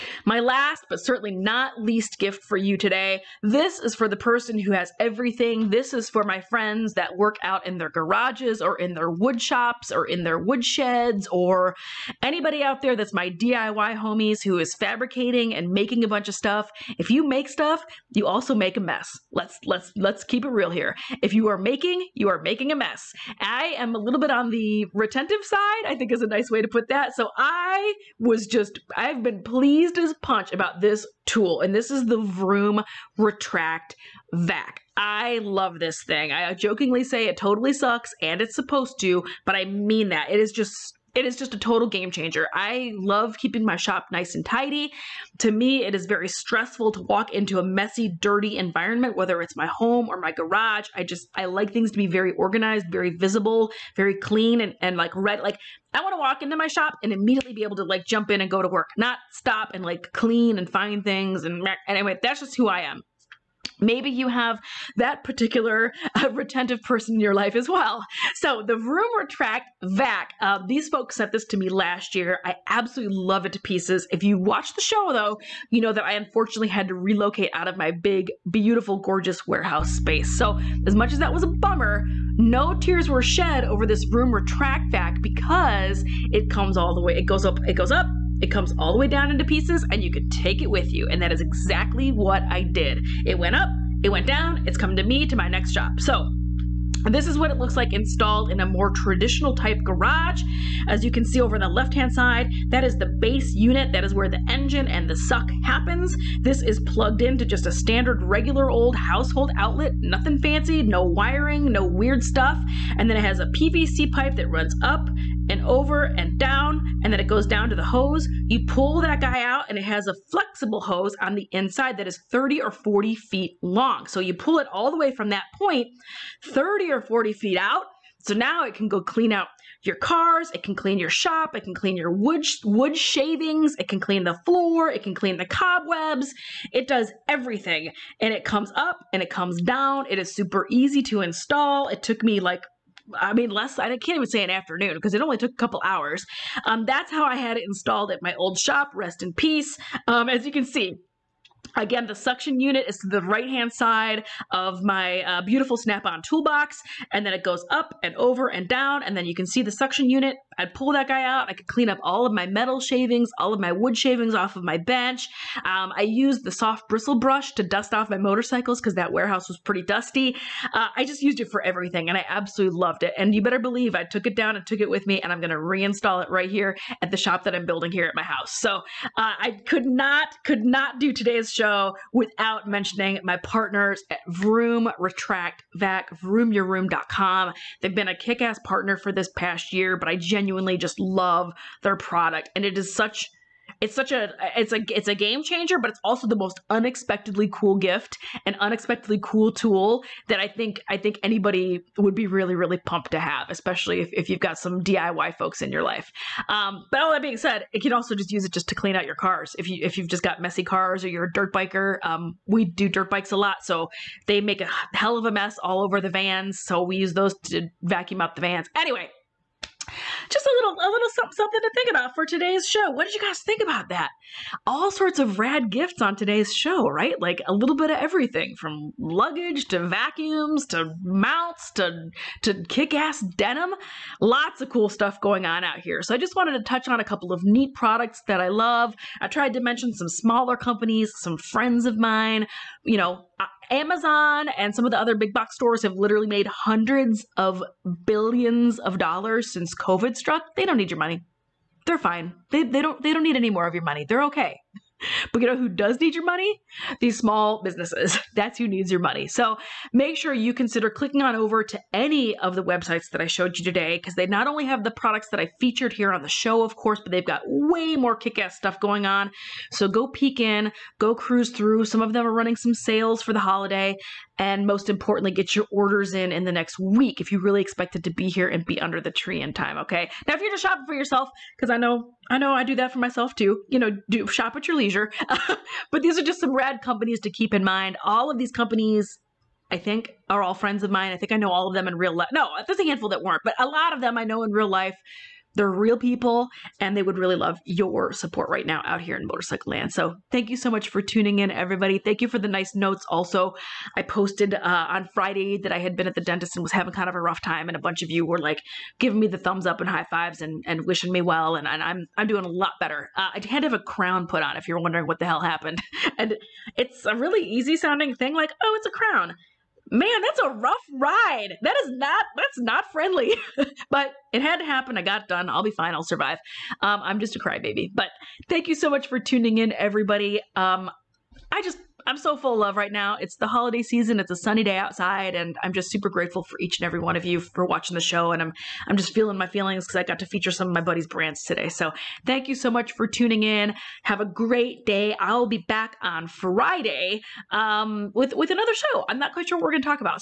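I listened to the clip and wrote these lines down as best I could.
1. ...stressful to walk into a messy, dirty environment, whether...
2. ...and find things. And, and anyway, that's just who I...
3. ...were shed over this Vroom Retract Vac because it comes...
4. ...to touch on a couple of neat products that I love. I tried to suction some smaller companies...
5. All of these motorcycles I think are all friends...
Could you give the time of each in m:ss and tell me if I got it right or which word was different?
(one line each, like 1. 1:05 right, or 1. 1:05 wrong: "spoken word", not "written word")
1. 0:46 right
2. 1:00 right
3. 1:23 right
4. 3:56 wrong: "mention", not "suction"
5. 4:48 wrong: "companies", not "motorcycles".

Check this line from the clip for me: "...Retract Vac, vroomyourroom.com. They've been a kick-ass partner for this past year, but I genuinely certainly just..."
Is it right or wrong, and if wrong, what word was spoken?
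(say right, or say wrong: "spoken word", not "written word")
wrong: "genuinely", not "certainly".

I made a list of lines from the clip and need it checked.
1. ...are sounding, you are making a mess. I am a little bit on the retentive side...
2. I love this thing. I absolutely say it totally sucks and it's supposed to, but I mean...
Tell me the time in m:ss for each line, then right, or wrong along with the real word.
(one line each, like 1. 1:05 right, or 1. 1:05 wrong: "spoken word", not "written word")
1. 0:21 wrong: "making", not "sounding"
2. 0:34 wrong: "jokingly", not "absolutely".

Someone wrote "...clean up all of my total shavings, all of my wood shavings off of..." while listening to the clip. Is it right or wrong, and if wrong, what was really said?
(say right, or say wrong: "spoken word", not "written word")
wrong: "metal", not "total".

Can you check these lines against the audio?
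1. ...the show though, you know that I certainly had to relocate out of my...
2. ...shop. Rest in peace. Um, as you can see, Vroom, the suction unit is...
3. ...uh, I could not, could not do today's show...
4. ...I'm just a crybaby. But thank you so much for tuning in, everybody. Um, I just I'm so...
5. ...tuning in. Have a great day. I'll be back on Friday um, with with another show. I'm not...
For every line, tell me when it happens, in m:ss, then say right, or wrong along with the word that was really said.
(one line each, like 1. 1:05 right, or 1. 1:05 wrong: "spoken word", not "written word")
1. 1:14 wrong: "unfortunately", not "certainly"
2. 2:28 wrong: "Again", not "Vroom"
3. 2:59 right
4. 5:27 right
5. 5:43 right.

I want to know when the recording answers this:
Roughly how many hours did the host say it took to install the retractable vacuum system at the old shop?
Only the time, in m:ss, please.
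2:25.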